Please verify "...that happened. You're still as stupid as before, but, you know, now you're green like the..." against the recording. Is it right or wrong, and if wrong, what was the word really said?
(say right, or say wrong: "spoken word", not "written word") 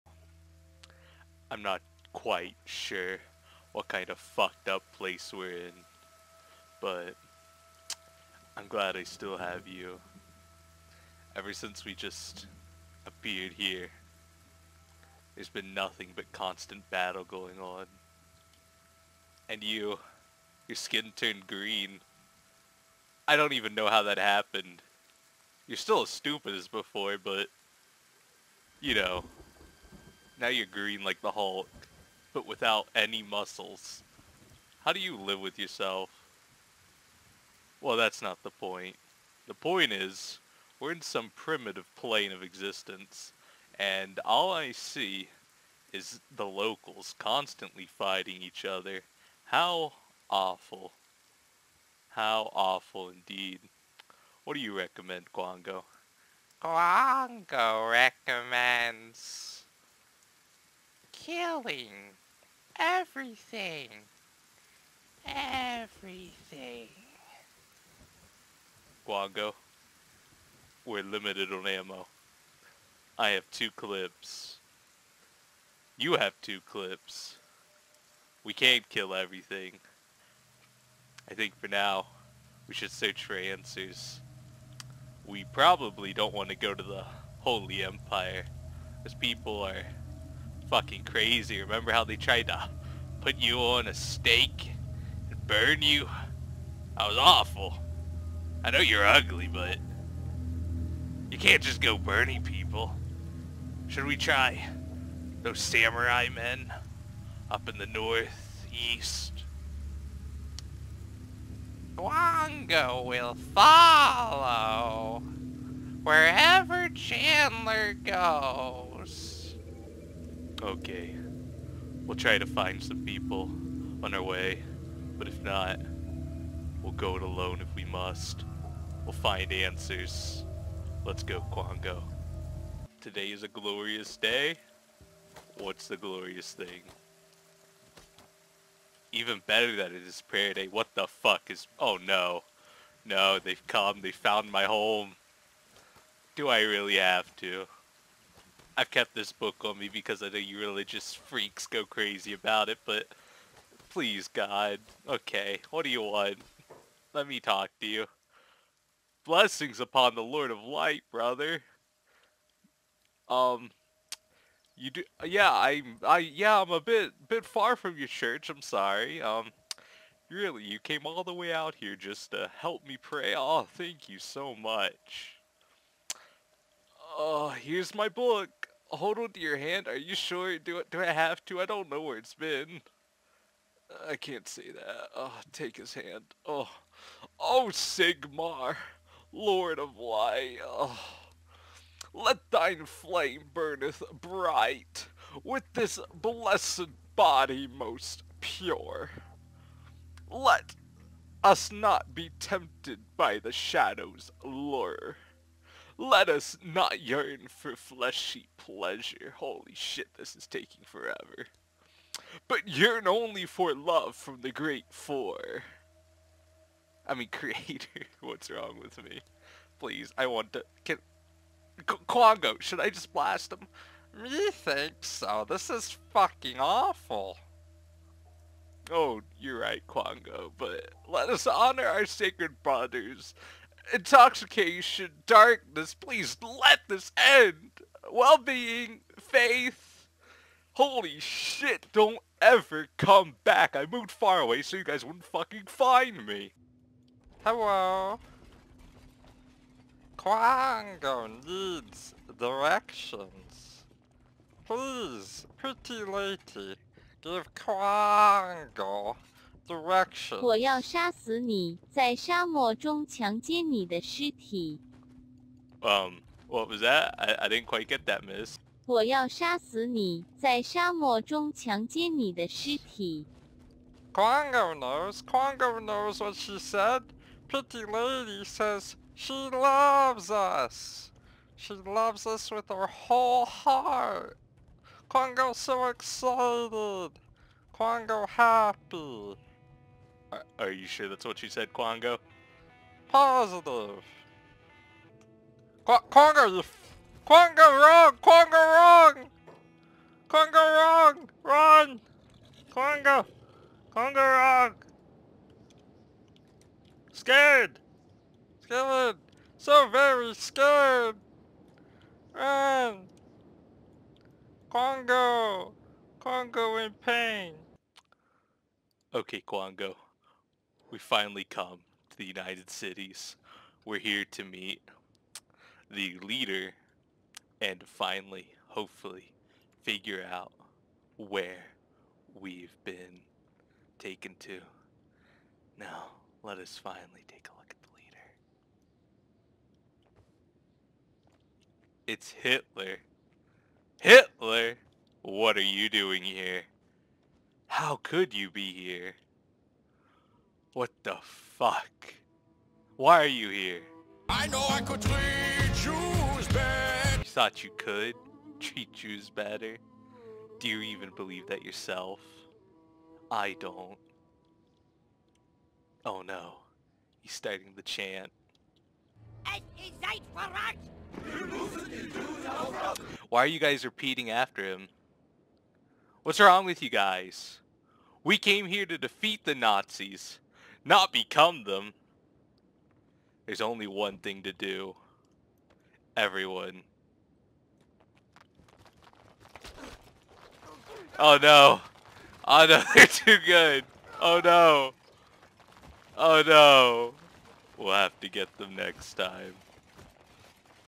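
right.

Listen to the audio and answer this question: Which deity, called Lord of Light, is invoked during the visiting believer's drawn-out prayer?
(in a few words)
Sigmar.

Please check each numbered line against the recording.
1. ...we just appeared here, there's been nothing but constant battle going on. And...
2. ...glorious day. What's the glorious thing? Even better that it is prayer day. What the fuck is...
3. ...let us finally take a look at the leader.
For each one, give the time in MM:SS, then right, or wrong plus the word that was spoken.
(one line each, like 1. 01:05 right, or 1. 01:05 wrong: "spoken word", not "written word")
1. 00:11 right
2. 02:13 right
3. 05:36 right.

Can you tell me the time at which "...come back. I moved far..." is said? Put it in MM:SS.
04:02.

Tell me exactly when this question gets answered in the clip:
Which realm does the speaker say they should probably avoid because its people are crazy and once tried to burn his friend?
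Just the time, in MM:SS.
01:27.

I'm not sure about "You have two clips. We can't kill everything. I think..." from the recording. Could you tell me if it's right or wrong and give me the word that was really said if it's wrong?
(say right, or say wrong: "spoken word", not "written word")
right.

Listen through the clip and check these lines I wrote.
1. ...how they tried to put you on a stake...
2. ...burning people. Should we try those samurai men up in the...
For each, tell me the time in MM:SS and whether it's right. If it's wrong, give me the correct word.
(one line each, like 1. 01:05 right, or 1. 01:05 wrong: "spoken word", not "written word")
1. 01:31 right
2. 01:41 right.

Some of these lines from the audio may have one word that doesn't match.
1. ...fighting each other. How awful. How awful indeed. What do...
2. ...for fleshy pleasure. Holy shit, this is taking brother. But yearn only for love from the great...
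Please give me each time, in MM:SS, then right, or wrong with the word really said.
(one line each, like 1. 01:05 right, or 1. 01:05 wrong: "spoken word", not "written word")
1. 00:47 right
2. 03:27 wrong: "forever", not "brother".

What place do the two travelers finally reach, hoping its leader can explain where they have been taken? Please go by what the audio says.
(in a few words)
United Cities.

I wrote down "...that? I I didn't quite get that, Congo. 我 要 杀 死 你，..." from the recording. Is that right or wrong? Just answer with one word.
wrong.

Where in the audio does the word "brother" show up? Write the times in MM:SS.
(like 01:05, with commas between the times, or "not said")
02:41, 03:52.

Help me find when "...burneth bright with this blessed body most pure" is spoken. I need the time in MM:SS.
03:13.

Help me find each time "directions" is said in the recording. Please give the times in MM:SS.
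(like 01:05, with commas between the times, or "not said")
04:12, 04:19.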